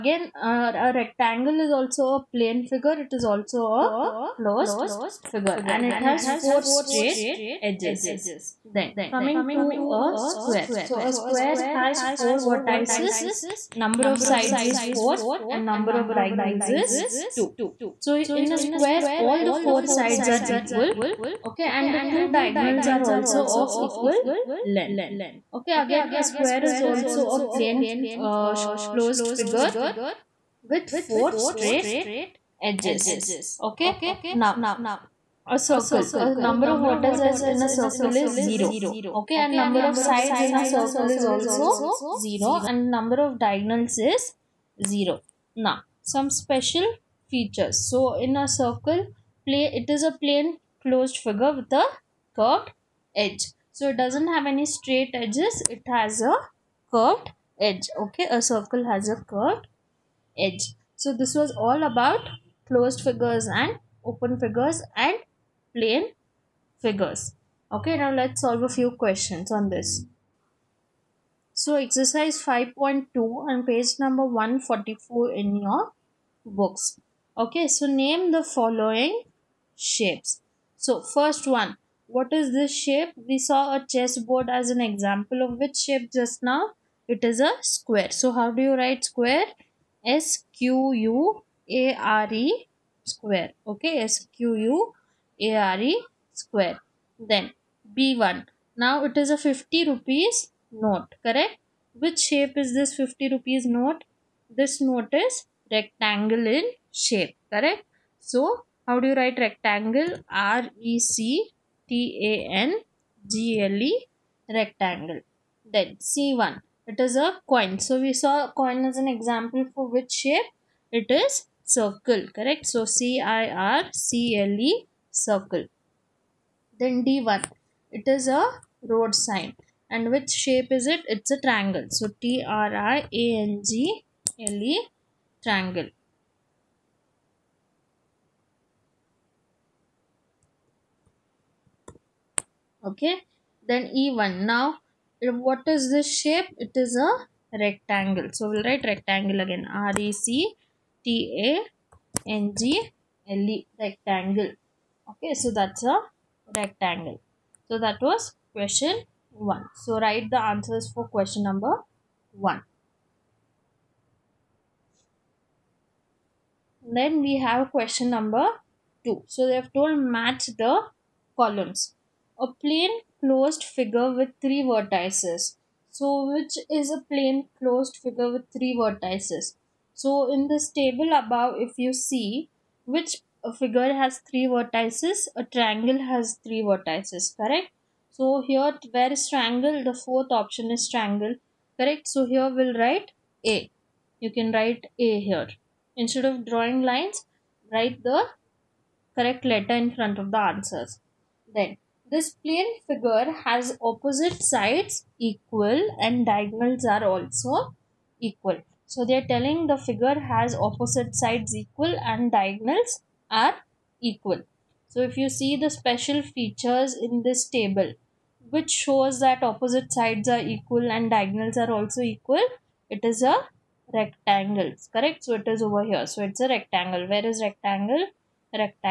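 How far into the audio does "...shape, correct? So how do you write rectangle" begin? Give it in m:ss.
1:46.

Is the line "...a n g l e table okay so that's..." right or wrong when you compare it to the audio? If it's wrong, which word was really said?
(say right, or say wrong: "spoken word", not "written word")
wrong: "rectangle", not "table".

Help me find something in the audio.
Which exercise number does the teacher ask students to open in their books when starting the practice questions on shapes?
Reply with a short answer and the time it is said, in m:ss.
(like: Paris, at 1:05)
5.2, at 1:11.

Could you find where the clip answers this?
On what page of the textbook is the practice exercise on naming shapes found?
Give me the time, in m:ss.
1:13.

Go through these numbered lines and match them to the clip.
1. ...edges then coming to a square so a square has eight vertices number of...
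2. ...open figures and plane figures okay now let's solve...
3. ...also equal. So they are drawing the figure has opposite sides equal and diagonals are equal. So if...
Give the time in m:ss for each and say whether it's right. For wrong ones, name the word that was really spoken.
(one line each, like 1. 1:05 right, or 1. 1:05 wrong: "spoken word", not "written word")
1. 0:07 wrong: "four", not "eight"
2. 1:04 right
3. 3:27 wrong: "telling", not "drawing".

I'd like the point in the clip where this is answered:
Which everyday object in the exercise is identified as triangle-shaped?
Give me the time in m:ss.
2:08.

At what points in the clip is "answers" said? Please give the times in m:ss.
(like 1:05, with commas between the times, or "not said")
2:40, 3:20.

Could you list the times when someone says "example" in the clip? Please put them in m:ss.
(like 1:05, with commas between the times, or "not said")
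1:24, 1:59.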